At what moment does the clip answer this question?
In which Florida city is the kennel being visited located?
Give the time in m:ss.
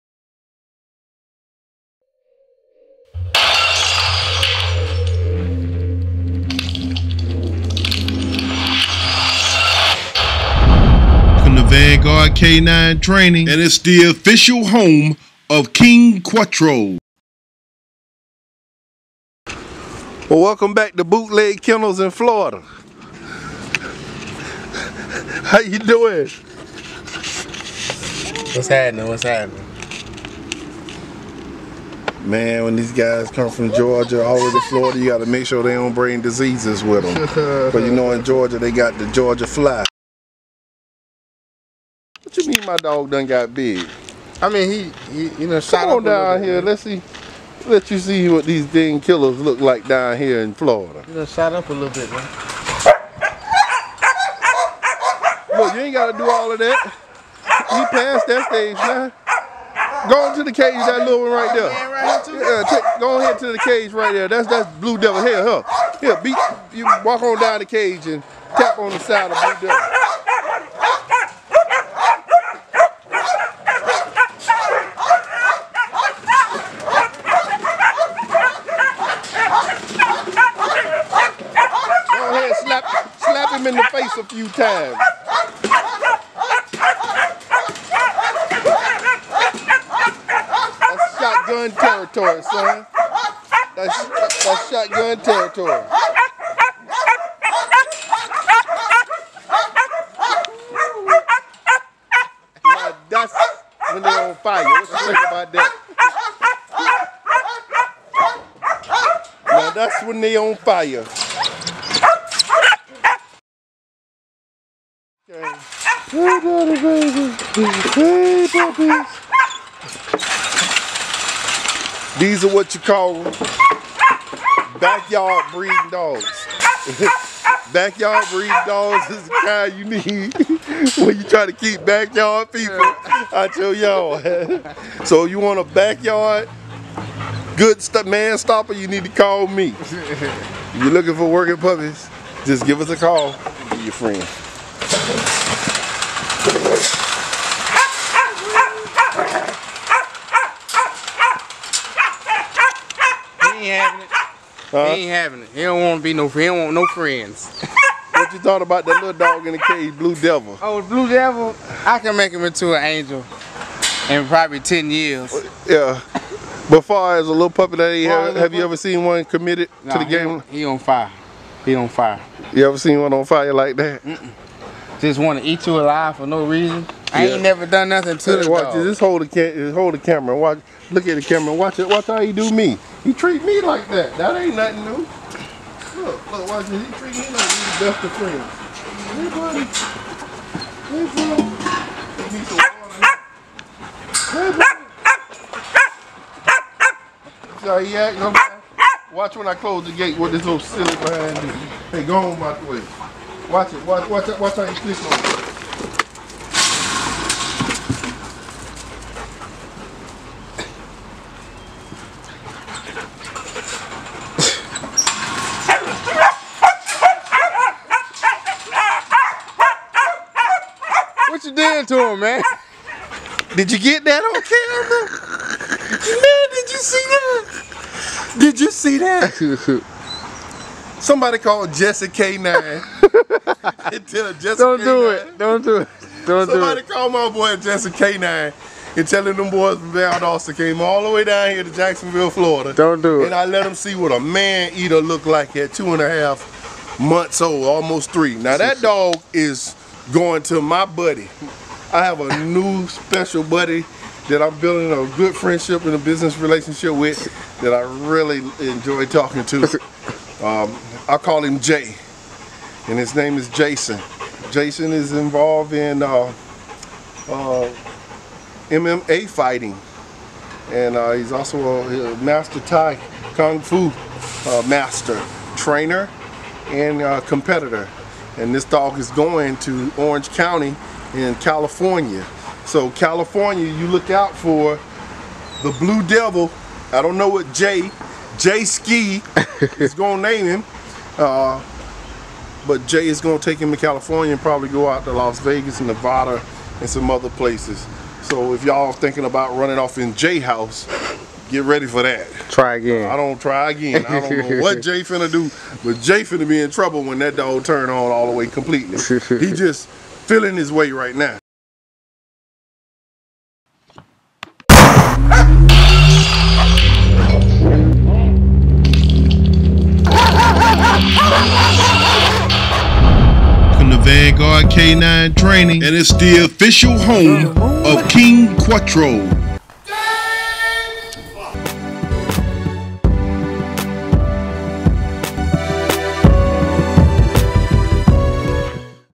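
4:01.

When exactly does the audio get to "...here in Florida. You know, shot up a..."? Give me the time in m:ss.
0:50.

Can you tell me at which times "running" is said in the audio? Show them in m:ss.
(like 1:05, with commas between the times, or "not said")
4:59.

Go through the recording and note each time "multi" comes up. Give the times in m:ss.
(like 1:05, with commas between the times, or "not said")
not said.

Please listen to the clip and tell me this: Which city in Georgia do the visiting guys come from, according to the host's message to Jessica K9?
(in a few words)
Valdosta.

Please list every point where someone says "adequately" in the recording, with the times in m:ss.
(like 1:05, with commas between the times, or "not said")
not said.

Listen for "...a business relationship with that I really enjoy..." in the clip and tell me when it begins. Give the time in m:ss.
4:15.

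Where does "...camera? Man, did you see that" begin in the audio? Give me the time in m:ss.
3:44.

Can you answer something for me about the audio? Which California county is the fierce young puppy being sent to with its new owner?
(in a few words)
Orange County.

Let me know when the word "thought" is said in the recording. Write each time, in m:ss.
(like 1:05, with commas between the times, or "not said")
2:38.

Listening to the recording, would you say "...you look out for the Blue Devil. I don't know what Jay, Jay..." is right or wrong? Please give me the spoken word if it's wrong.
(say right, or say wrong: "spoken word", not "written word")
right.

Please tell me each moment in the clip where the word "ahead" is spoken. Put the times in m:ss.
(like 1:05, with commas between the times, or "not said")
1:03.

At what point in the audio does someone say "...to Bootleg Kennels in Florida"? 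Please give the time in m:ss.
0:20.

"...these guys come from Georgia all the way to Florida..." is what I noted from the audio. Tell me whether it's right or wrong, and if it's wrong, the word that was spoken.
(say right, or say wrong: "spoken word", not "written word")
right.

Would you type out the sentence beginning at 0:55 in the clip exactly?
Look, you ain't got to do all of that.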